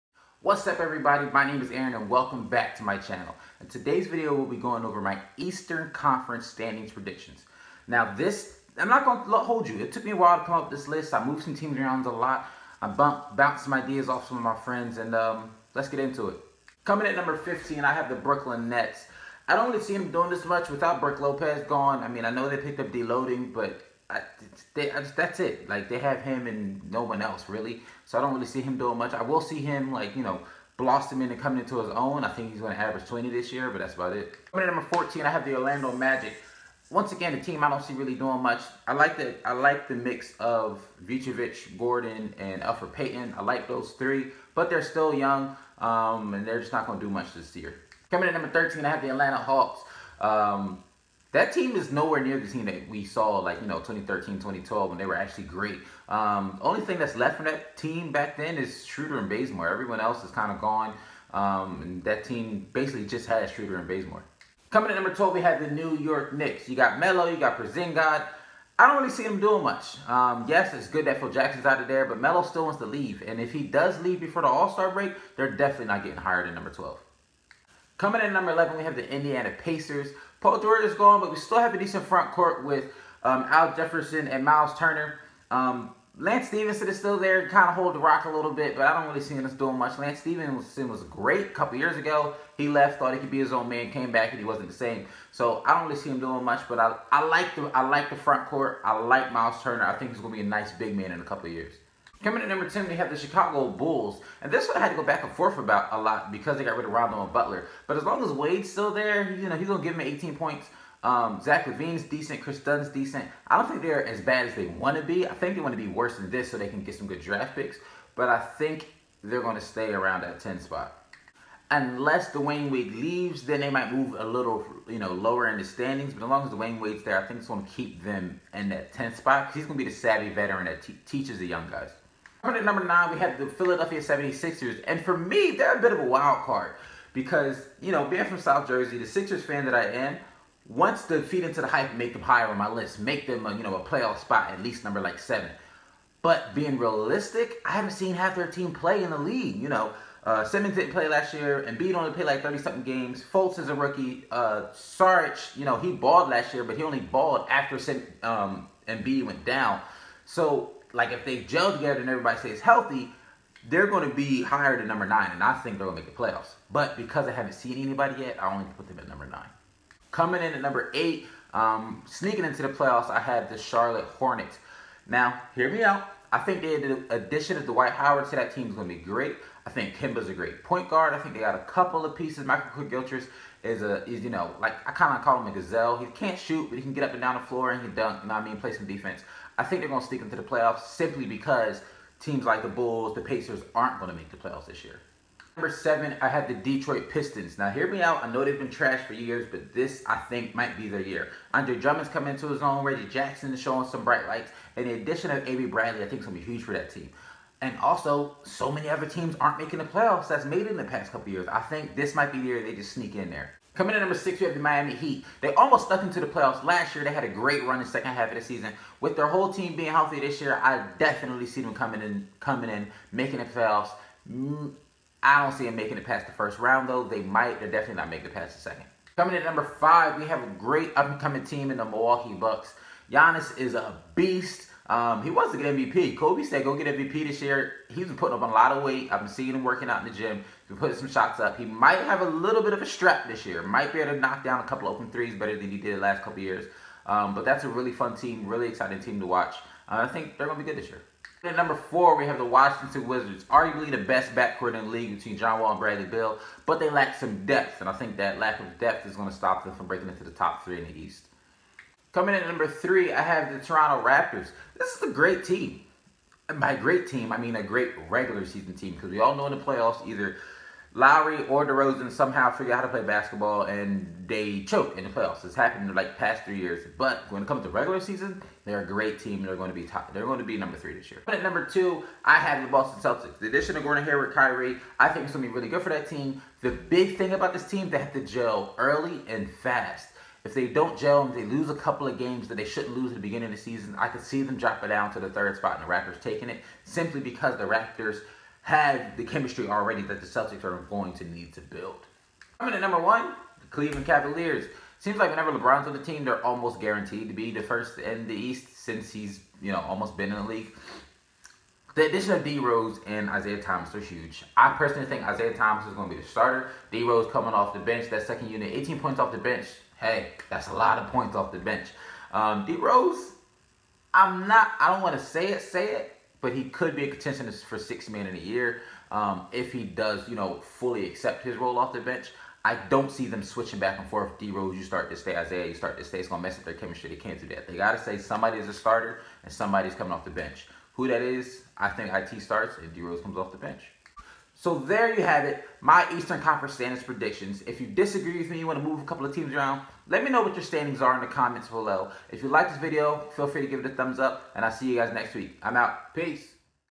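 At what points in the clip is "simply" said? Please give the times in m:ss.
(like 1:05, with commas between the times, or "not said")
3:10, 4:56.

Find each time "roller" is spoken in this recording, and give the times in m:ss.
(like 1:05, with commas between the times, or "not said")
not said.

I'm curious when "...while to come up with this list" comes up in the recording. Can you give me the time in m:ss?
0:10.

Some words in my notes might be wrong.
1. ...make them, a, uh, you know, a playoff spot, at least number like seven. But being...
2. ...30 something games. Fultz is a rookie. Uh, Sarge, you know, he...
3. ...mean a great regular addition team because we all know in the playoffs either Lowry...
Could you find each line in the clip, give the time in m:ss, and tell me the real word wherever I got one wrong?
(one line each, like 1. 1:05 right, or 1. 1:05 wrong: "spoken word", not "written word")
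1. 2:22 right
2. 2:32 right
3. 4:27 wrong: "season", not "addition".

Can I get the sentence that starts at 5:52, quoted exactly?
If you like this video, feel free to give it a thumbs up, and I'll see you guys next week.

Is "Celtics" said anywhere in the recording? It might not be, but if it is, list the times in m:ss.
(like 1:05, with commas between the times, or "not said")
4:43, 5:00.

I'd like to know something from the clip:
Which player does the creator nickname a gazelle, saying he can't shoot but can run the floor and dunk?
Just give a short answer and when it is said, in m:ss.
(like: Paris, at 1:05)
Michael Gilchrist, at 3:02.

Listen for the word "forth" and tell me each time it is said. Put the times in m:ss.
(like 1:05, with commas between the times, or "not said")
1:45, 5:34.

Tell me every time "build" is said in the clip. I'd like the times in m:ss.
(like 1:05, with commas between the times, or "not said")
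5:01.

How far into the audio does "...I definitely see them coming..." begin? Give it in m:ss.
3:40.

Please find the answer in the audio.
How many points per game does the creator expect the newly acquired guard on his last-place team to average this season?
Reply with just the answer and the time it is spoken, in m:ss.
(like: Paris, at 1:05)
20, at 0:33.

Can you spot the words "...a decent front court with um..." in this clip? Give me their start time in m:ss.
1:21.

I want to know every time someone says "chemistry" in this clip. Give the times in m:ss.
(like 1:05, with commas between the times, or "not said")
4:59, 5:36.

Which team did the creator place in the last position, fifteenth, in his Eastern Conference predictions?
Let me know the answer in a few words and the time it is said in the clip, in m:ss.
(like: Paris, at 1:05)
Brooklyn Nets, at 0:18.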